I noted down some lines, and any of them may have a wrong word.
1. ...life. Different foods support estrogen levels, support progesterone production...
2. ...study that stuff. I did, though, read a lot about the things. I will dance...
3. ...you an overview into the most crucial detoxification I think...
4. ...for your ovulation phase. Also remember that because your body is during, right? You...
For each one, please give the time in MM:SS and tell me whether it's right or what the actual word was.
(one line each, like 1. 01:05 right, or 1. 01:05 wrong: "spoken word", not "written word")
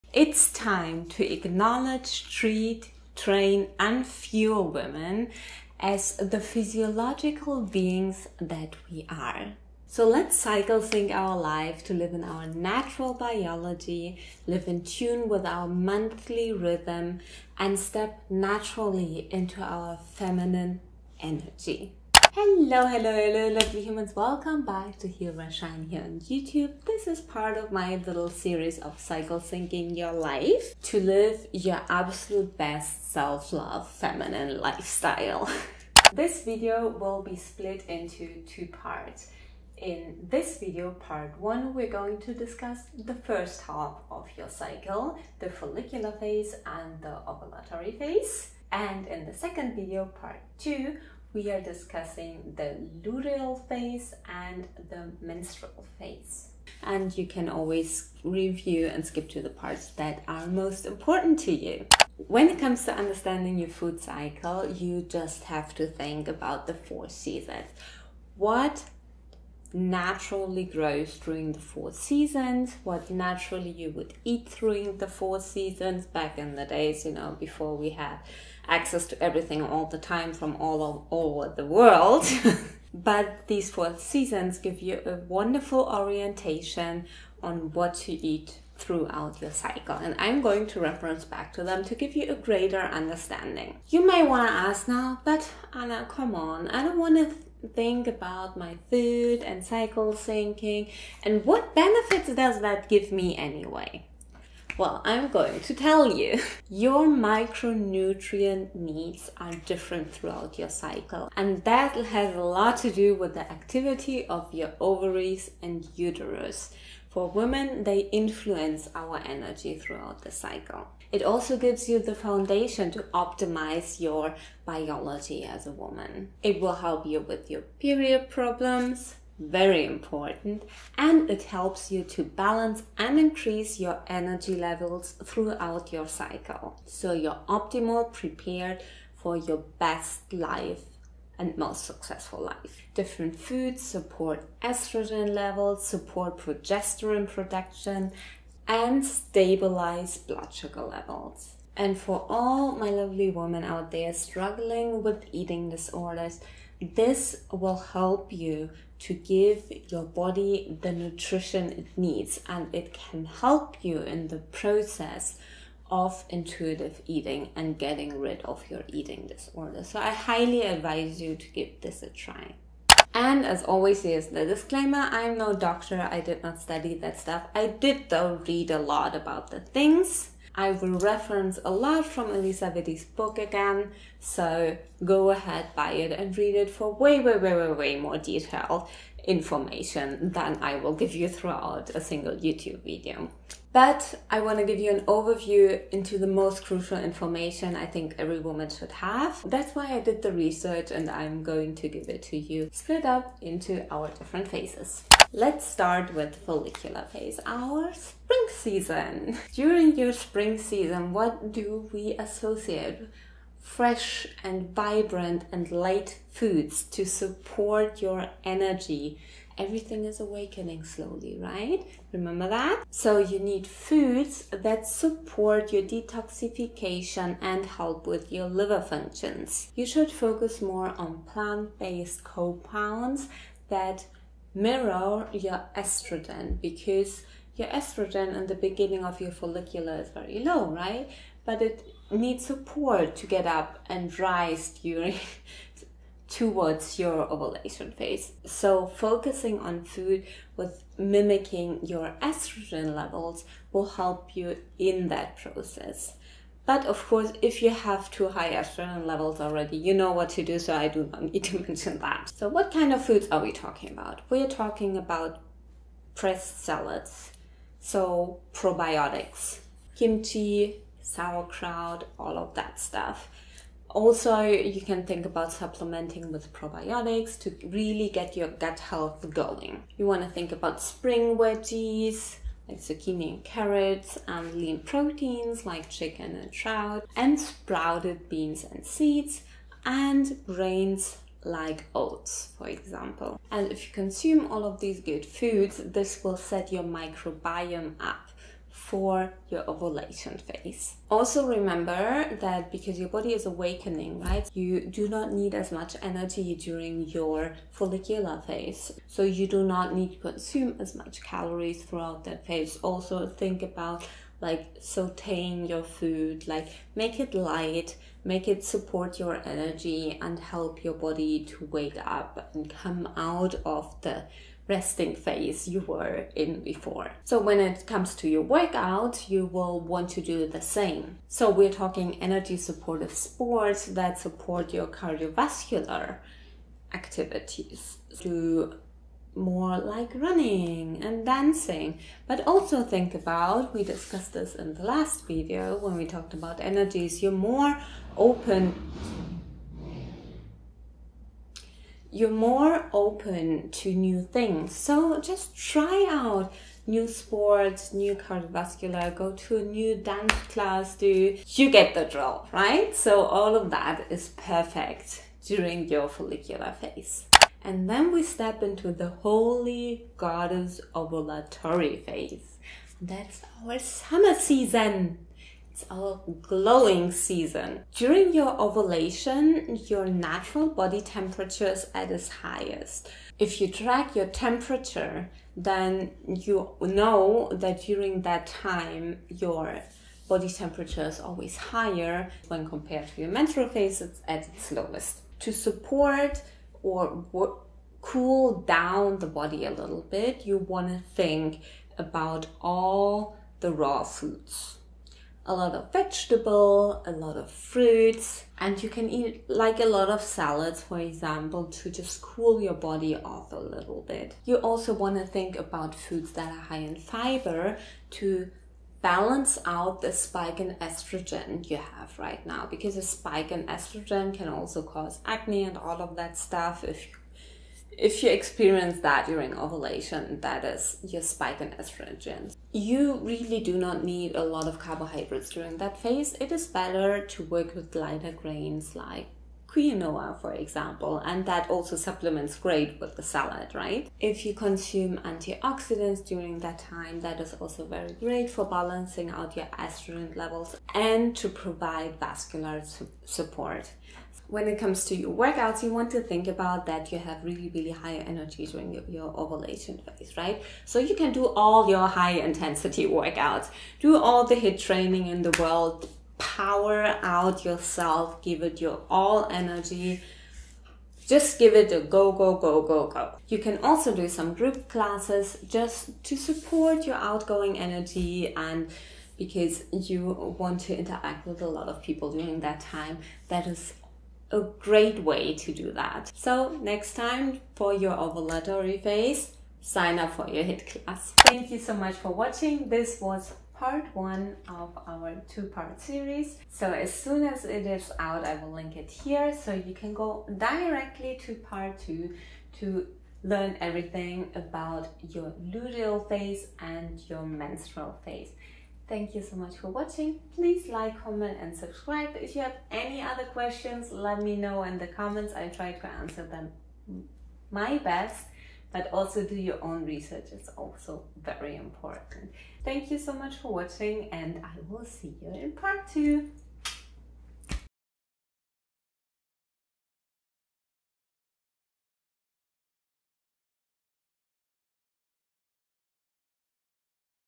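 1. 02:22 right
2. 02:56 wrong: "reference", not "dance"
3. 03:14 wrong: "information", not "detoxification"
4. 04:58 wrong: "awakening", not "during".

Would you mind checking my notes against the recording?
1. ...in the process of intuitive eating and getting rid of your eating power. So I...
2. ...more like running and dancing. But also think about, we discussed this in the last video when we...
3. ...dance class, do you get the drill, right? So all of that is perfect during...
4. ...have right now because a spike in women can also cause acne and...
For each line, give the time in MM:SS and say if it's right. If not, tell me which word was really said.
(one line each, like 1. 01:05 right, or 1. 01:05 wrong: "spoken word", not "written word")
1. 02:44 wrong: "disorder", not "power"
2. 05:39 right
3. 05:59 right
4. 07:01 wrong: "estrogen", not "women".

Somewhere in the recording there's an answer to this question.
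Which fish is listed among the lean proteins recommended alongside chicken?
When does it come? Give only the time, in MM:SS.
04:46.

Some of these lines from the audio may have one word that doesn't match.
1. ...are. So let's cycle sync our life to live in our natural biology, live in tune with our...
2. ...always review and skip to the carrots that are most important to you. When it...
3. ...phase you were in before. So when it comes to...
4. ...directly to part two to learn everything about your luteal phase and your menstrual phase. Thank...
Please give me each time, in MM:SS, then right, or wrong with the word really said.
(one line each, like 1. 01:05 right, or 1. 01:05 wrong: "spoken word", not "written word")
1. 00:09 right
2. 00:57 wrong: "parts", not "carrots"
3. 05:25 right
4. 08:20 right.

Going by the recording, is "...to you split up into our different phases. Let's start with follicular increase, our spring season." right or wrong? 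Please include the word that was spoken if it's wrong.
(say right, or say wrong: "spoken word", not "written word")
wrong: "phase", not "increase".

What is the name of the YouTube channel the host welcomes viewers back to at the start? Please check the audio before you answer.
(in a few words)
Human Shine.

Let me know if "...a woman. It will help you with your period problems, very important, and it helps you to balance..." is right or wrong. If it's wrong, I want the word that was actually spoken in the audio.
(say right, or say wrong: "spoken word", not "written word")
right.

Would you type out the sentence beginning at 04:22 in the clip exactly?
So what kind of foods are we talking about?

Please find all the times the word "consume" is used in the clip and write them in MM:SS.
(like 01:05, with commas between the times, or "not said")
04:53, 05:10, 07:24.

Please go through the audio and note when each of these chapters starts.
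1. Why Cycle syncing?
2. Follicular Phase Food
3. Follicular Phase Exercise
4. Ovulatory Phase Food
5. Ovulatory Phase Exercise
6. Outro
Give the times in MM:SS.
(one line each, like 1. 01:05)
1. 01:02
2. 03:25
3. 05:30
4. 06:07
5. 07:35
6. 08:14.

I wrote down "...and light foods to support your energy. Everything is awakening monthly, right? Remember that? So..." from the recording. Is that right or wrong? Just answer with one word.
wrong.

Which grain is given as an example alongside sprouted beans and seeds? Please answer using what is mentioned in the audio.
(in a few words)
Oats.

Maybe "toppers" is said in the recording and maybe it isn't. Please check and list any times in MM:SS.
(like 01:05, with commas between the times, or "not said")
not said.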